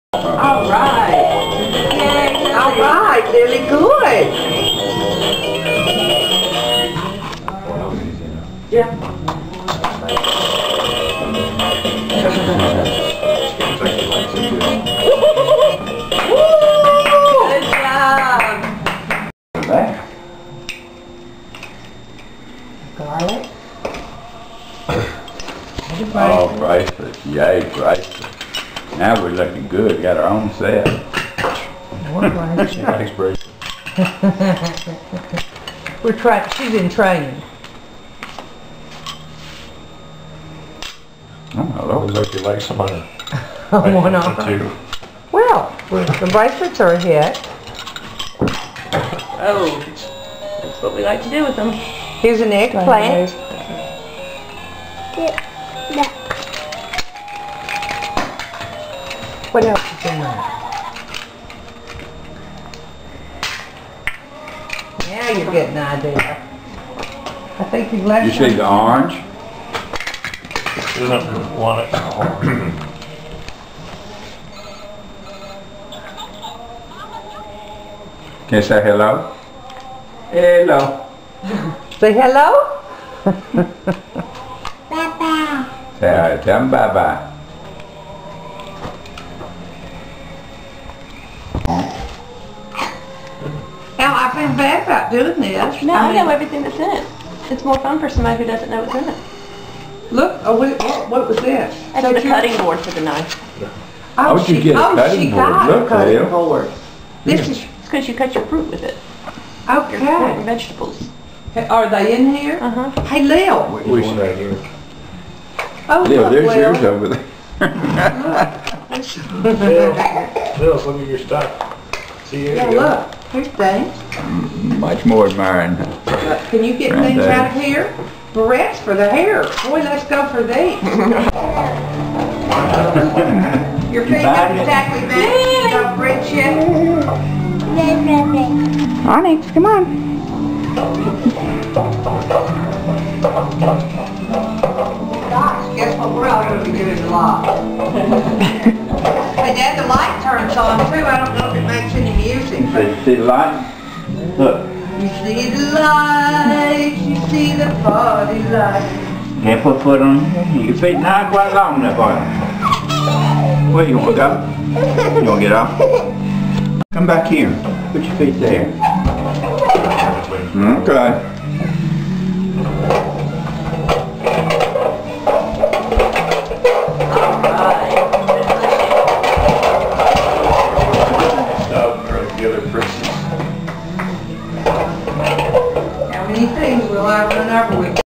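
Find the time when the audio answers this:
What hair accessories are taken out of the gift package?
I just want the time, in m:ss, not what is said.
2:08.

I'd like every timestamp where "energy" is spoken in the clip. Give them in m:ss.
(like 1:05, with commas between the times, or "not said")
not said.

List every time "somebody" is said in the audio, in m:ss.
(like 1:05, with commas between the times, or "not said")
0:42, 1:38.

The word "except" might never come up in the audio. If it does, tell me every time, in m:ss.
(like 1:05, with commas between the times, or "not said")
not said.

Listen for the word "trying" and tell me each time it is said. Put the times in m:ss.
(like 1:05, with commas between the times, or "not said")
0:36.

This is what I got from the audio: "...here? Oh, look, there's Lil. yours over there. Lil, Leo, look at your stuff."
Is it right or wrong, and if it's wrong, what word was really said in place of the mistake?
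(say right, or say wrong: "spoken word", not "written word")
right.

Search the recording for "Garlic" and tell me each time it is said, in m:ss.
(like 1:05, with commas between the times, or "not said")
0:22.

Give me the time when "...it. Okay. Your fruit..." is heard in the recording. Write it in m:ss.
1:48.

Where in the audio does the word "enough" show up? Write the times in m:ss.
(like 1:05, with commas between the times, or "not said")
2:41.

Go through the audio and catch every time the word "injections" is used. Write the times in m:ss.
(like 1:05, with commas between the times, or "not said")
not said.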